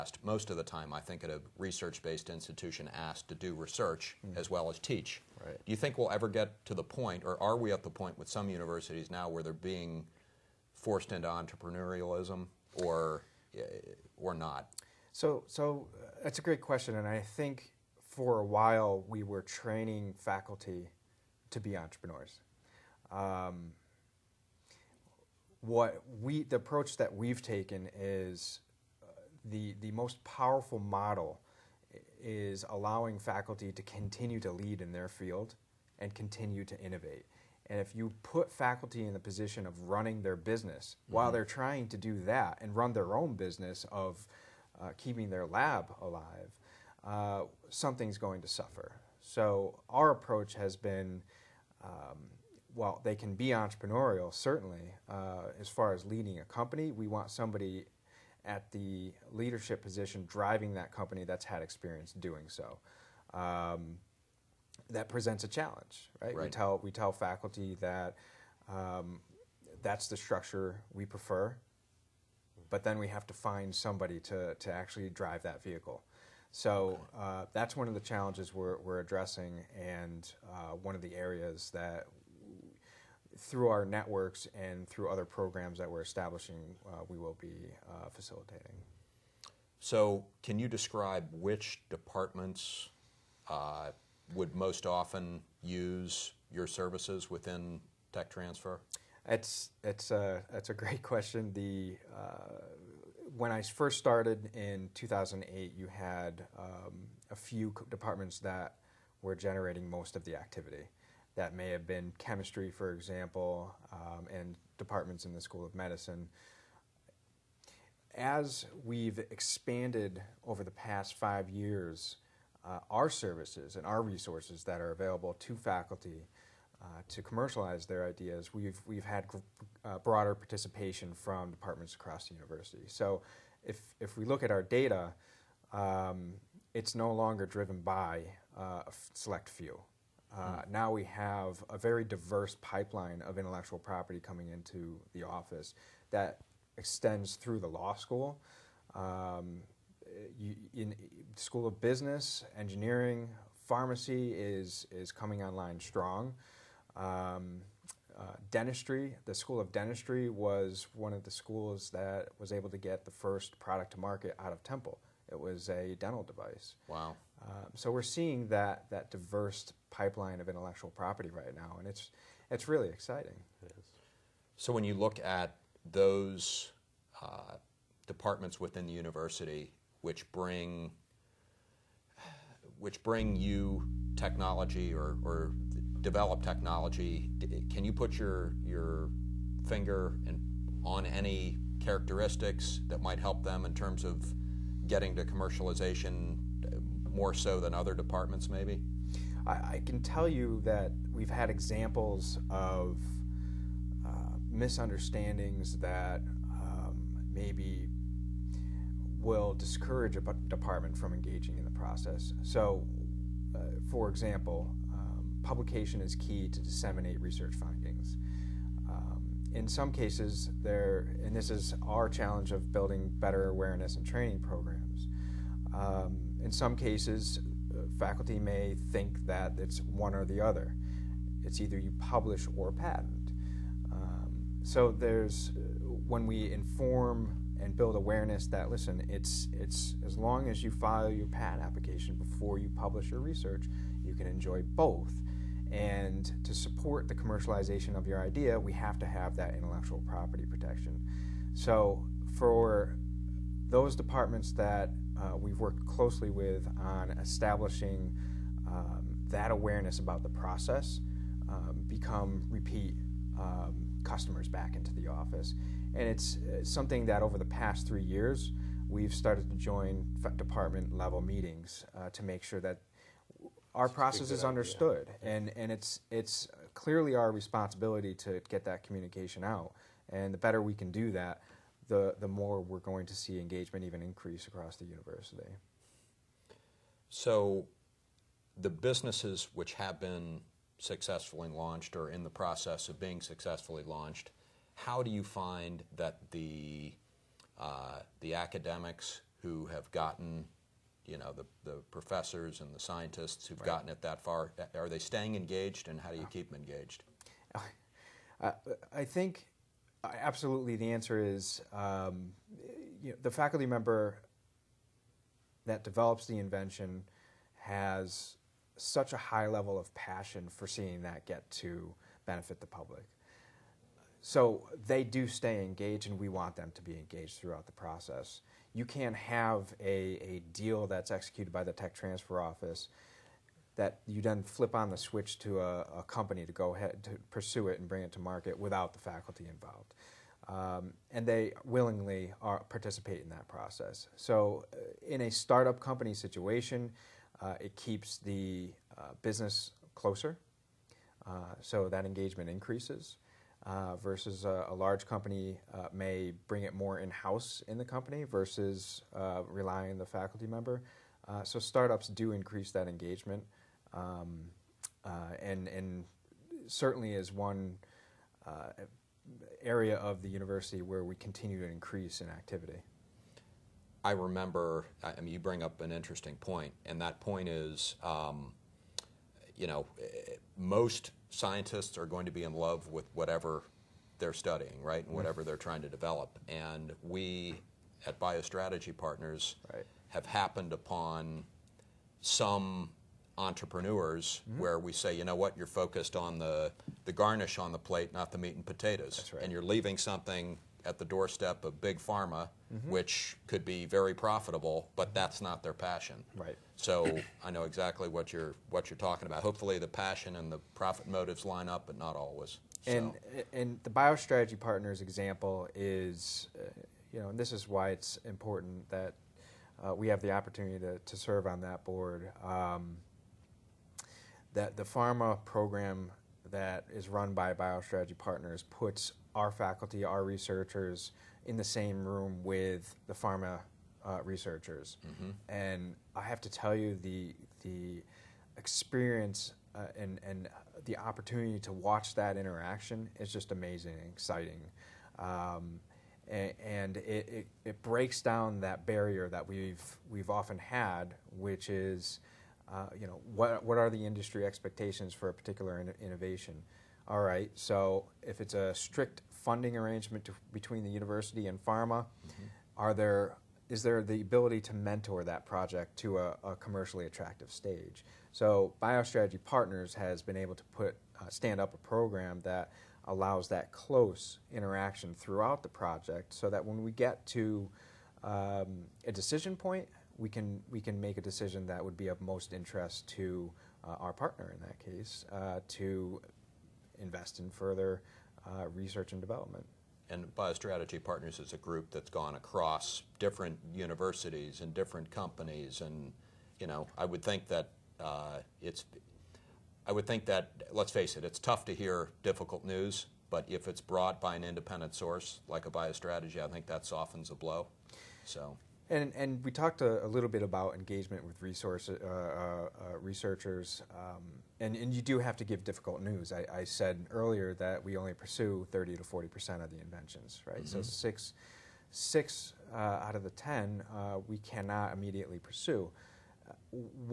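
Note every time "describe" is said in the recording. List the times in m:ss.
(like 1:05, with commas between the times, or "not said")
1:30.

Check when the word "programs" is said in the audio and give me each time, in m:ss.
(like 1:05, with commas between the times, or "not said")
1:25, 3:44, 7:05, 7:51.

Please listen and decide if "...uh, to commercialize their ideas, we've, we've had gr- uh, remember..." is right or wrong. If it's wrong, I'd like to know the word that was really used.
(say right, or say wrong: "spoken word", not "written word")
wrong: "broader", not "remember".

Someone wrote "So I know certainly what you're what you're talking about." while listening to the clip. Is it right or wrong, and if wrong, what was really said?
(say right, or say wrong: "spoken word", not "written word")
wrong: "exactly", not "certainly".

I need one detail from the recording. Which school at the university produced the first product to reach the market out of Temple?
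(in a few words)
School of Dentistry.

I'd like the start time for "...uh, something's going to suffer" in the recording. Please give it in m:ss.
0:47.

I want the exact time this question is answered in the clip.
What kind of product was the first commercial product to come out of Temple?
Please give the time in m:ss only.
2:45.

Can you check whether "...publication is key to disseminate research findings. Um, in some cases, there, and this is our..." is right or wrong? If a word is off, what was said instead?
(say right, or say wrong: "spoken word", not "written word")
right.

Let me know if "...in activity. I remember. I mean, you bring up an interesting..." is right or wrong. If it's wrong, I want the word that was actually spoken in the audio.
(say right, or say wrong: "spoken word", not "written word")
right.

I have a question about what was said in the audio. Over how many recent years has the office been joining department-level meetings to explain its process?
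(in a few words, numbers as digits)
3 years.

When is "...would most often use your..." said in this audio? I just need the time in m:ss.
1:34.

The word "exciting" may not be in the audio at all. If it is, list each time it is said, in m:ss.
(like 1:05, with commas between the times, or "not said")
2:52, 7:24.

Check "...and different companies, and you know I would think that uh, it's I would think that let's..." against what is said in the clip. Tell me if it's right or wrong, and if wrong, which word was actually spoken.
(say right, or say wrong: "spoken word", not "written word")
right.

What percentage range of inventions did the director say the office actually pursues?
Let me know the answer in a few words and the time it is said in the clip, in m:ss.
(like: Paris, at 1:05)
30 to 40 percent, at 8:38.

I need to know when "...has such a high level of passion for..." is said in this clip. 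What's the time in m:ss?
5:17.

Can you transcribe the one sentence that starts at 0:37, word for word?
And if you put faculty in the position of running their business mm-hmm.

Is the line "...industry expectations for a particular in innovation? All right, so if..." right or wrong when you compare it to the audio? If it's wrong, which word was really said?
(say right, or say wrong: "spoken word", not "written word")
right.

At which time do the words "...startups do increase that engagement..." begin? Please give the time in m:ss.
6:01.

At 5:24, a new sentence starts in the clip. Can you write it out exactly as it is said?
So they do stay engaged, and we want them to be engaged throughout the process.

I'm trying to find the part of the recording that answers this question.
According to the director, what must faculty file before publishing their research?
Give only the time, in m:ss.
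4:01.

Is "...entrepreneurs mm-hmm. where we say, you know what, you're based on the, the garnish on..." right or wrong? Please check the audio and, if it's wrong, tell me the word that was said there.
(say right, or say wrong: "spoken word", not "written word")
wrong: "focused", not "based".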